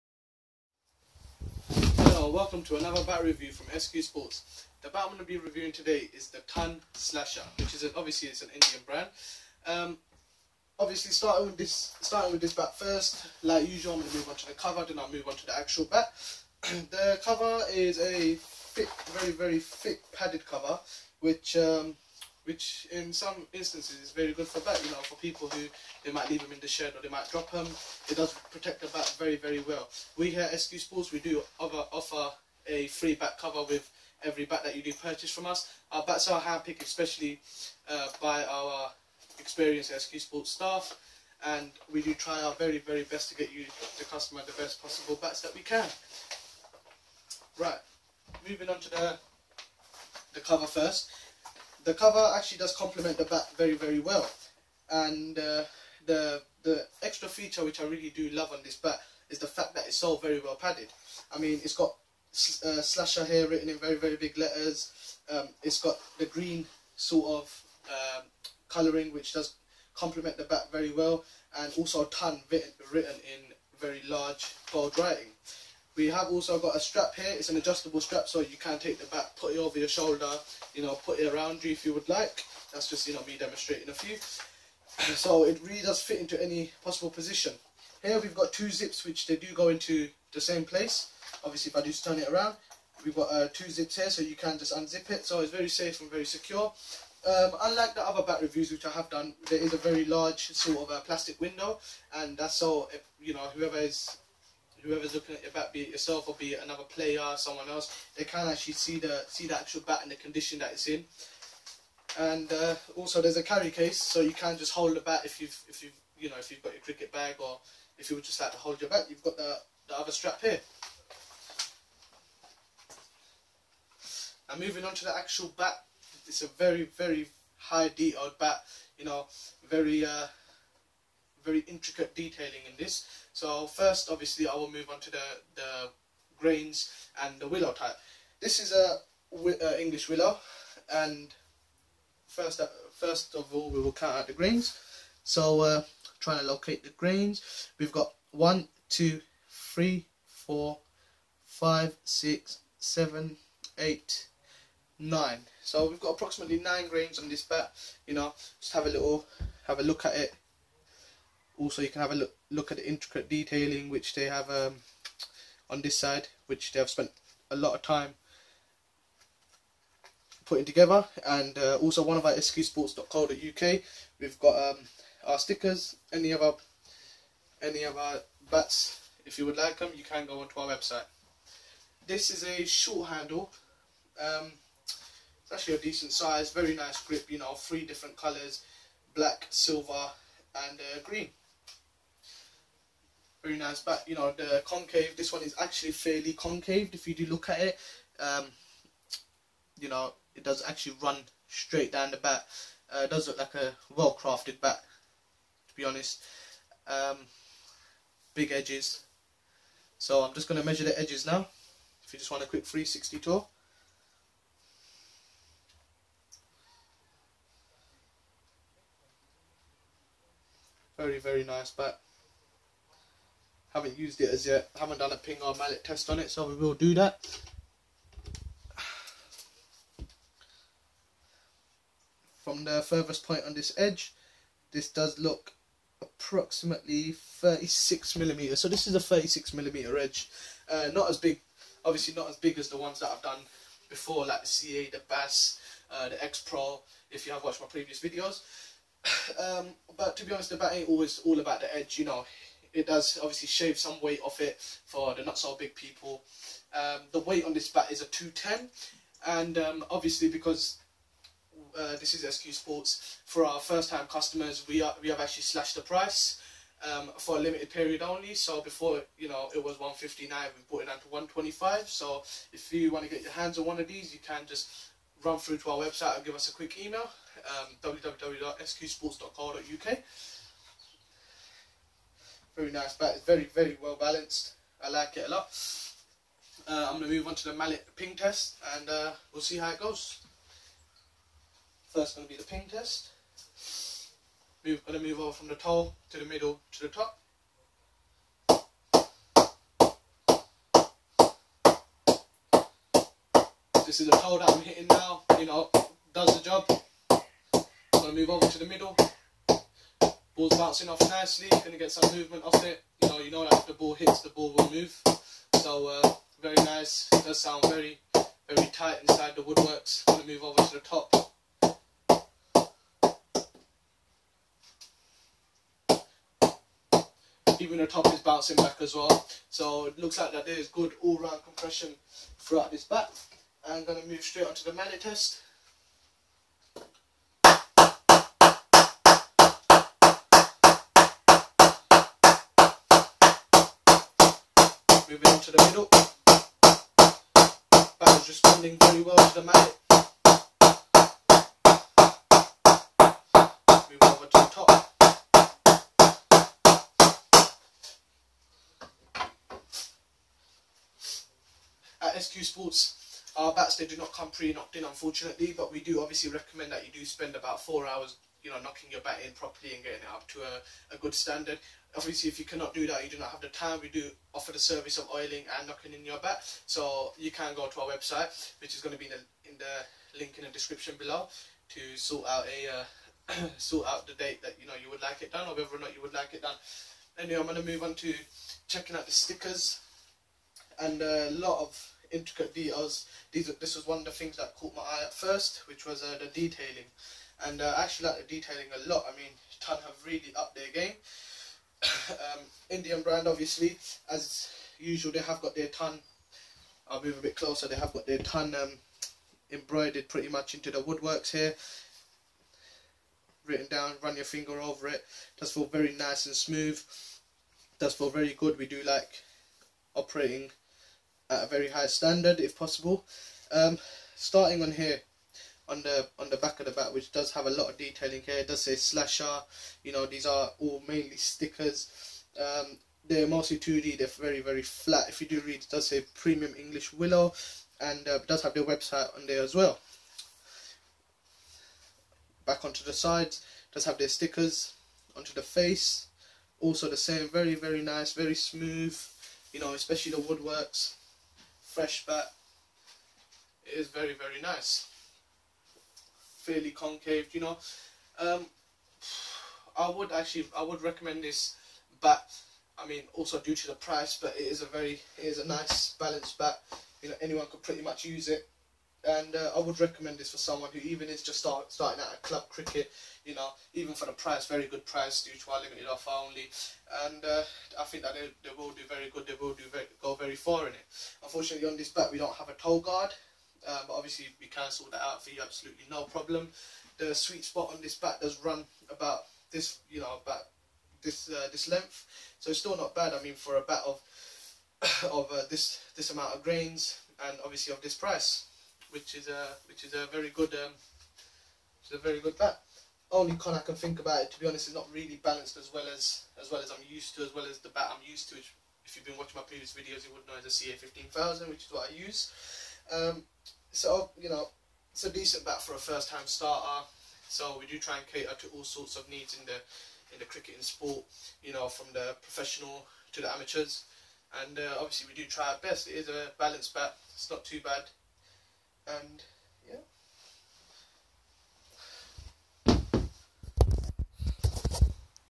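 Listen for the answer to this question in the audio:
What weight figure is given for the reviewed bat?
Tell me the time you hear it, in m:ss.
4:18.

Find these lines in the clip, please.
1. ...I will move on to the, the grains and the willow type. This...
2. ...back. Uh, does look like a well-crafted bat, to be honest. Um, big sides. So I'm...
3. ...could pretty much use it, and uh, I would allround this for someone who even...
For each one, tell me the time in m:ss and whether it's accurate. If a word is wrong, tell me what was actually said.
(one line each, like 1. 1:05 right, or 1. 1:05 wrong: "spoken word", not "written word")
1. 2:14 right
2. 3:22 wrong: "edges", not "sides"
3. 7:47 wrong: "recommend", not "allround".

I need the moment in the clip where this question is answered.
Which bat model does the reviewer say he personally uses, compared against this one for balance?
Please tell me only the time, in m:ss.
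8:30.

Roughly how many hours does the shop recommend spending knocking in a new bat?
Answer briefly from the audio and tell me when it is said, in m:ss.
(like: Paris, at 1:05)
4 hours, at 6:07.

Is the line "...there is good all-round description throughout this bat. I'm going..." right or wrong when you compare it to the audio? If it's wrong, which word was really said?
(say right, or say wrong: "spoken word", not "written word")
wrong: "compression", not "description".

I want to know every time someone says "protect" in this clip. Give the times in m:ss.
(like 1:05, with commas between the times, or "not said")
0:28.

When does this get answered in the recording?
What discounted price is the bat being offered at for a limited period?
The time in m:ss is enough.
4:31.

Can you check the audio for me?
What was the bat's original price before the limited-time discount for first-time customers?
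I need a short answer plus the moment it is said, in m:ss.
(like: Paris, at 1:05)
159, at 4:29.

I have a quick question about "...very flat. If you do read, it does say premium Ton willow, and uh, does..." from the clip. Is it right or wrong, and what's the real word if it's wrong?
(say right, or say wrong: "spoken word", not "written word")
wrong: "English", not "Ton".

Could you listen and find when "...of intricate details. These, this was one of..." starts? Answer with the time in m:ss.
6:31.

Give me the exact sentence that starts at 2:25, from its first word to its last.
So uh, trying to locate the grains, we've got one, two, three, four, five, six, seven, eight, nine.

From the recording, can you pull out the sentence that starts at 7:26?
Also the same, very very nice, very smooth.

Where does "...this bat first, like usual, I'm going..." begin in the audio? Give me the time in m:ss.
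0:12.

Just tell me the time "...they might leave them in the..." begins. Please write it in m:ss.
0:26.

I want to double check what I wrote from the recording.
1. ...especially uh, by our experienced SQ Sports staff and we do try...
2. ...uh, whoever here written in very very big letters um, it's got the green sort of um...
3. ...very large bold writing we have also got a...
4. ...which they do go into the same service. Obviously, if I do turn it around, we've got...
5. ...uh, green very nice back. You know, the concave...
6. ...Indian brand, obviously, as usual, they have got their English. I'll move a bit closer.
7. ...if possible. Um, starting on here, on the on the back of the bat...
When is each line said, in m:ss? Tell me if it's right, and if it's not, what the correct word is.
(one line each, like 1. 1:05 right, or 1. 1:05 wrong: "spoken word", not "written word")
1. 0:36 right
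2. 1:02 wrong: "slasher", not "whoever"
3. 1:13 right
4. 1:29 wrong: "place", not "service"
5. 3:10 right
6. 6:42 wrong: "Ton", not "English"
7. 7:02 right.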